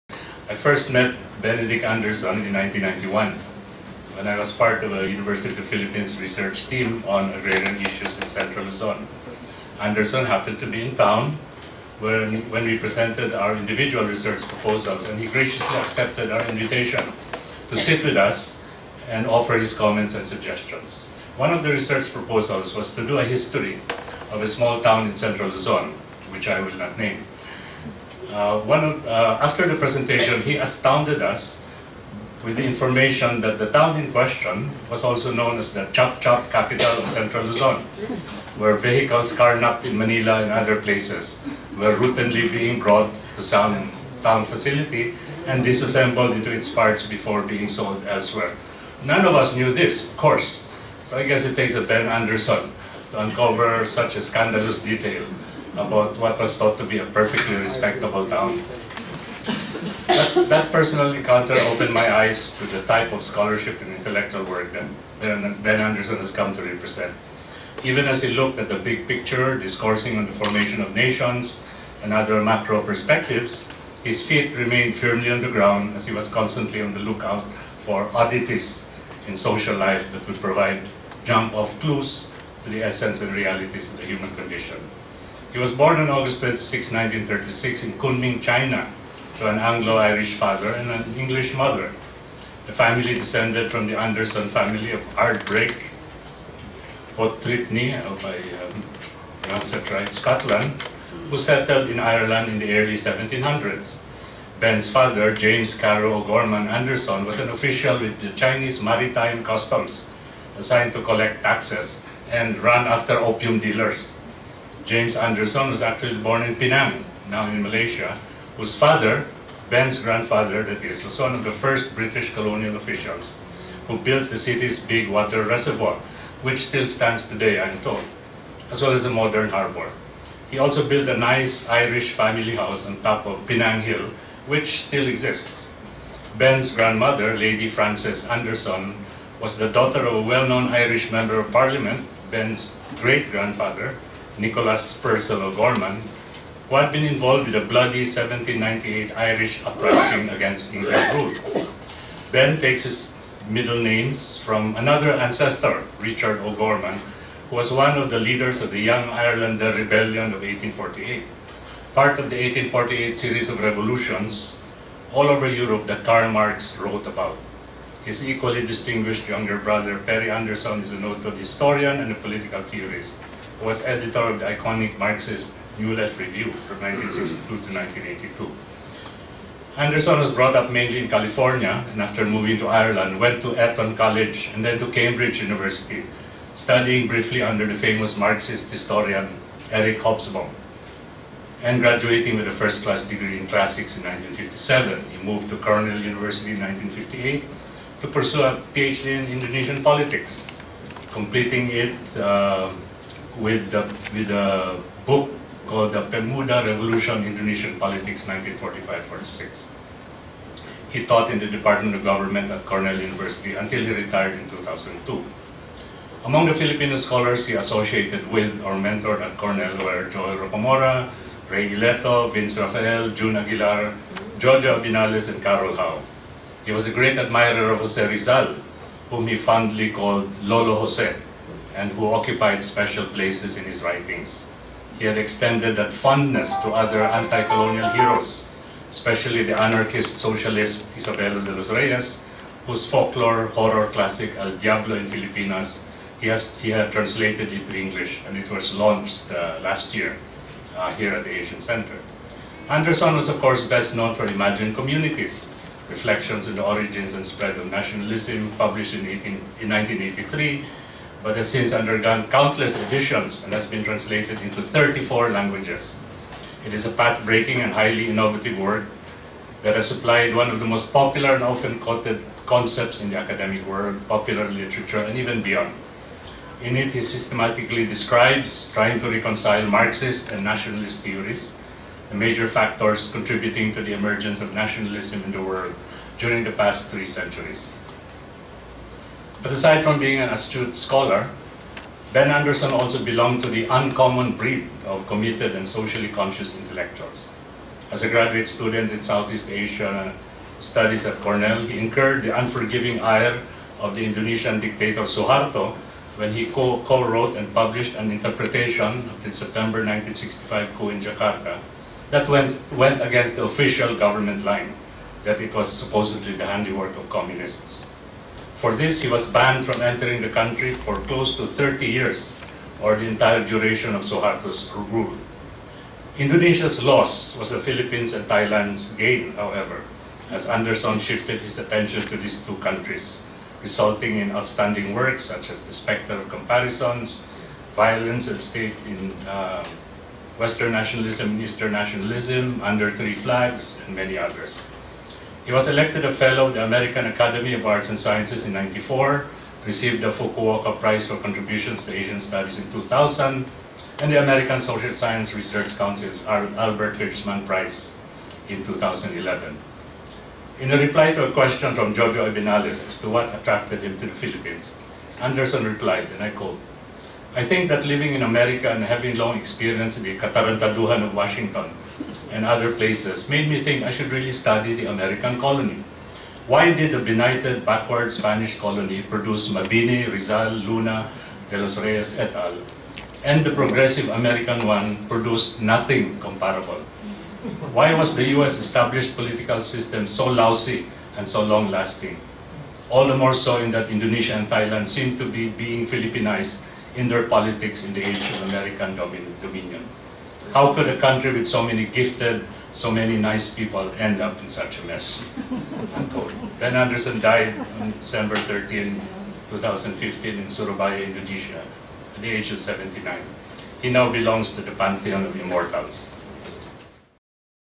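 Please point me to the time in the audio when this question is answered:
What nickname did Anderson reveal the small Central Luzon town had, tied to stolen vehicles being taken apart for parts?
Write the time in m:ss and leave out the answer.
0:35.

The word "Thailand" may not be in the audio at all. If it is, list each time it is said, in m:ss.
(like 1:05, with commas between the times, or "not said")
5:28, 6:34.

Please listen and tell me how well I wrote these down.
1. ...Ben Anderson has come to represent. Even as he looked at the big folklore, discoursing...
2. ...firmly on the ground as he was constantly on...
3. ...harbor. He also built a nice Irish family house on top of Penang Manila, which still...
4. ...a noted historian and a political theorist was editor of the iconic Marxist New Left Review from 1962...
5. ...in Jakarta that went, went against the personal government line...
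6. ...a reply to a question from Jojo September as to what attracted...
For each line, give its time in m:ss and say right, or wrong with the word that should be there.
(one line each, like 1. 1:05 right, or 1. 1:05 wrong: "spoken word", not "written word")
1. 1:05 wrong: "picture", not "folklore"
2. 1:14 right
3. 2:09 wrong: "Hill", not "Manila"
4. 2:50 right
5. 5:10 wrong: "official", not "personal"
6. 6:00 wrong: "Abinales", not "September".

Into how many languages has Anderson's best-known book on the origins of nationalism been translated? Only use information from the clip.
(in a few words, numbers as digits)
34.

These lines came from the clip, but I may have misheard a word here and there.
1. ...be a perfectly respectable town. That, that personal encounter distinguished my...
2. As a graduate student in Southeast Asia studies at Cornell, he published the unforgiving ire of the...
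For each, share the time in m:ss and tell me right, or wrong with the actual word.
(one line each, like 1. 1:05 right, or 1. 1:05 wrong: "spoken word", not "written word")
1. 0:56 wrong: "opened", not "distinguished"
2. 4:57 wrong: "incurred", not "published".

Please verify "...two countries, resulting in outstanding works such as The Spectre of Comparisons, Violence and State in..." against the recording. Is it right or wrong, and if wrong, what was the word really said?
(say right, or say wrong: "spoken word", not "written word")
right.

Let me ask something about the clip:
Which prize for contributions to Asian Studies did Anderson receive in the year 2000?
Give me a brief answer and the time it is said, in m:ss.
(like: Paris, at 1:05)
Fukuoka Prize, at 5:50.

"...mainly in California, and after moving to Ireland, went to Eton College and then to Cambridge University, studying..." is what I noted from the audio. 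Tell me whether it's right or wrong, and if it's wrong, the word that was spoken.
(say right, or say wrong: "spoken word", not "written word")
right.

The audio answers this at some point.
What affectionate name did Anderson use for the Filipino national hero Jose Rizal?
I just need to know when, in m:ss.
3:50.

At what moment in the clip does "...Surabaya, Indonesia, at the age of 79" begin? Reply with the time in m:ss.
6:50.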